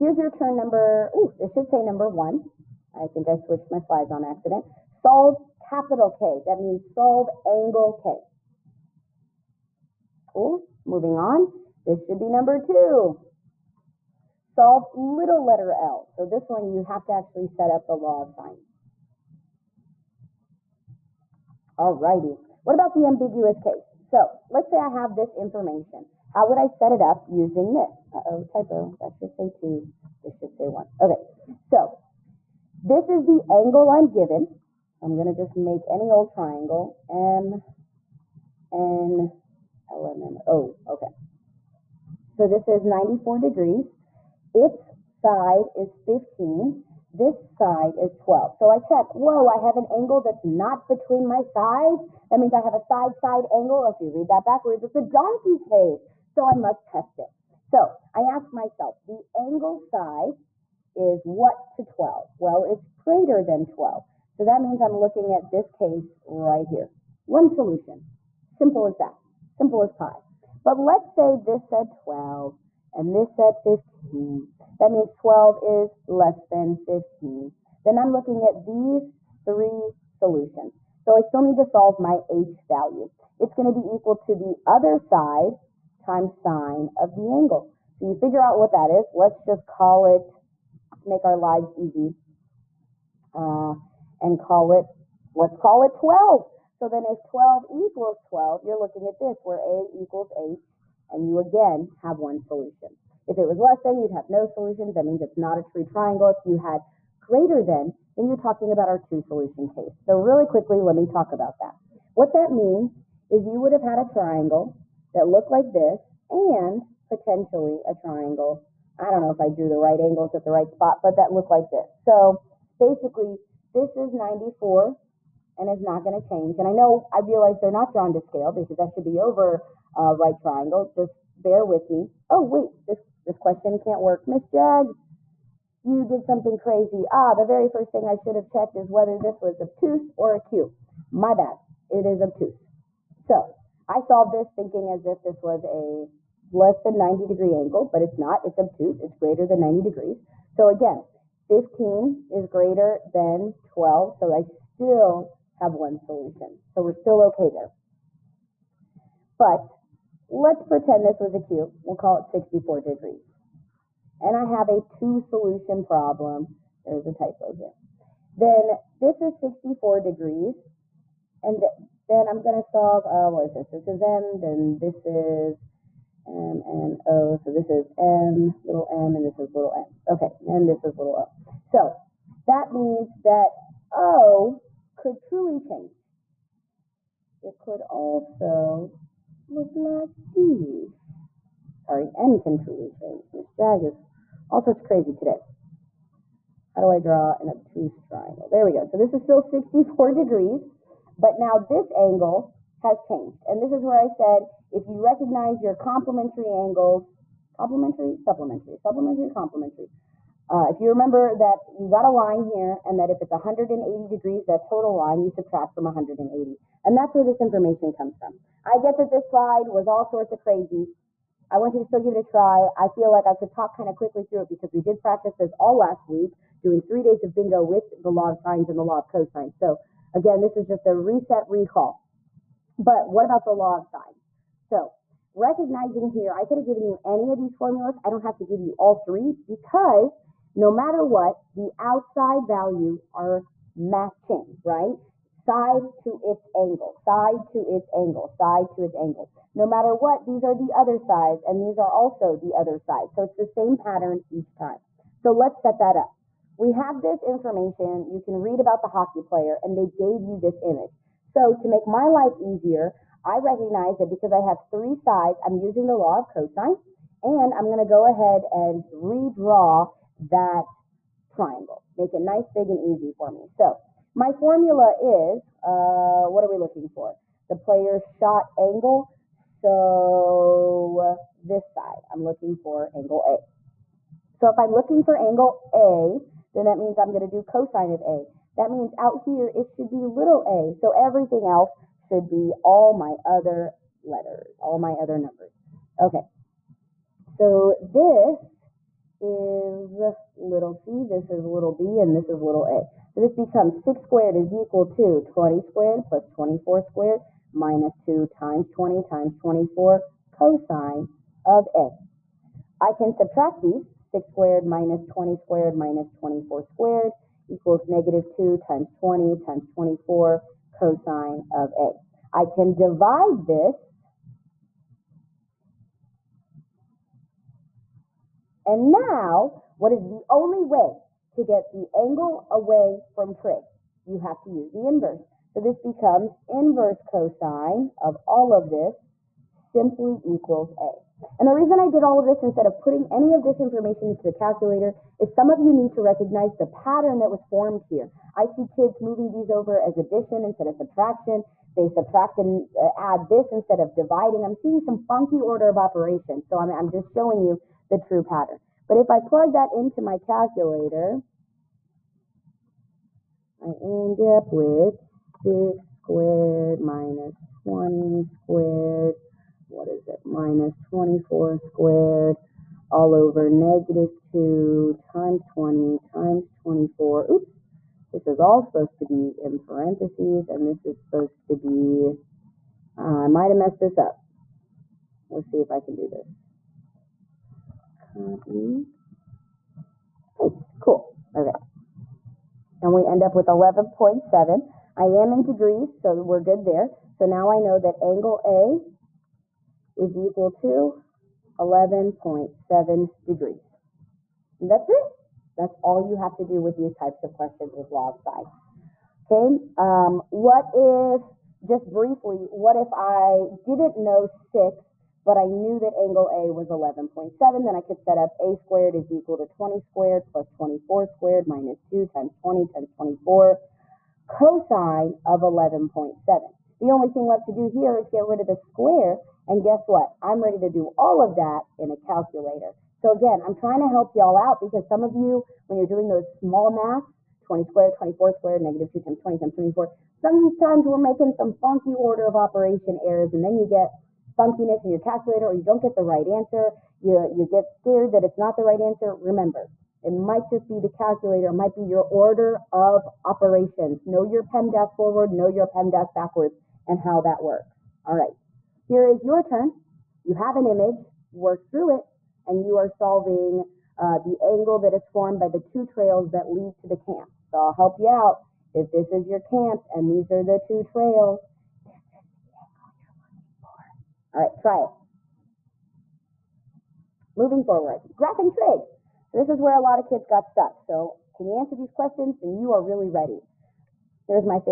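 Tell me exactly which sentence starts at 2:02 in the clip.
So basically, this is 94 and it's not going to change.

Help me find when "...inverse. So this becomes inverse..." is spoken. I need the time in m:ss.
5:34.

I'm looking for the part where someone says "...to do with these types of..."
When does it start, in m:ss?
6:46.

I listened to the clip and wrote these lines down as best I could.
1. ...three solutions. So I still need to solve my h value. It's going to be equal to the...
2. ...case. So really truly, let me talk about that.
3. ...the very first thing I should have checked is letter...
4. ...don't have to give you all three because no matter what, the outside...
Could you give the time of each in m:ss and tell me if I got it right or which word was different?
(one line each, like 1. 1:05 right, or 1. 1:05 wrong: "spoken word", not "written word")
1. 1:19 right
2. 1:49 wrong: "quickly", not "truly"
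3. 2:17 wrong: "whether", not "letter"
4. 3:58 right.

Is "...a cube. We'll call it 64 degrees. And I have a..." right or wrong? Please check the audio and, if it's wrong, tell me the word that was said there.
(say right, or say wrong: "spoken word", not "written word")
right.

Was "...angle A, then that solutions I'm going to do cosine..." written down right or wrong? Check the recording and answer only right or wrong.
wrong.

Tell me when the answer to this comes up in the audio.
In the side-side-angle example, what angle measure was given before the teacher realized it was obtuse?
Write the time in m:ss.
0:42.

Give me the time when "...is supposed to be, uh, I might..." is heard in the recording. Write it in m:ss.
6:20.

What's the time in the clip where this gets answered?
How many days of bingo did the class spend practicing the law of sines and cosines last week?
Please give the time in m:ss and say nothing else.
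3:46.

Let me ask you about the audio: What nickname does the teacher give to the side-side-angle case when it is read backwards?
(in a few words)
donkey case.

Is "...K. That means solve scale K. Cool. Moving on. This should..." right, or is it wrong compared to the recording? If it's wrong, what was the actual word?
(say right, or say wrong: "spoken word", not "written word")
wrong: "angle", not "scale".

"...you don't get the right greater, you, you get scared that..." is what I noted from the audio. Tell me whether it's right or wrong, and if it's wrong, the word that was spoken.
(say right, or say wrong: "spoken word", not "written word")
wrong: "answer", not "greater".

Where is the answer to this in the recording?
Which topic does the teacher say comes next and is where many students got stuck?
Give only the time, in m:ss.
7:58.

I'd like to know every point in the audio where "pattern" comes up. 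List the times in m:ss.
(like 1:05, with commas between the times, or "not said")
4:13, 5:46, 5:58.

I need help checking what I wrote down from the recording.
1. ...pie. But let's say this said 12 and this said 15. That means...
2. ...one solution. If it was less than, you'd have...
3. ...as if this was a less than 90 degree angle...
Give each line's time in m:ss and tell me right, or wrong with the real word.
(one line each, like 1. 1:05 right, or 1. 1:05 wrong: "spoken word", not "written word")
1. 1:09 right
2. 1:42 right
3. 2:24 right.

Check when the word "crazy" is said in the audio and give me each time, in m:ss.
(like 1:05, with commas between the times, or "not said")
2:16, 3:14, 3:40.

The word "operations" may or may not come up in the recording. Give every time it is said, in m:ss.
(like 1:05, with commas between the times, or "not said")
5:55, 7:22, 7:33.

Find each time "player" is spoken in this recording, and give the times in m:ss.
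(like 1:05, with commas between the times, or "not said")
4:19, 4:37.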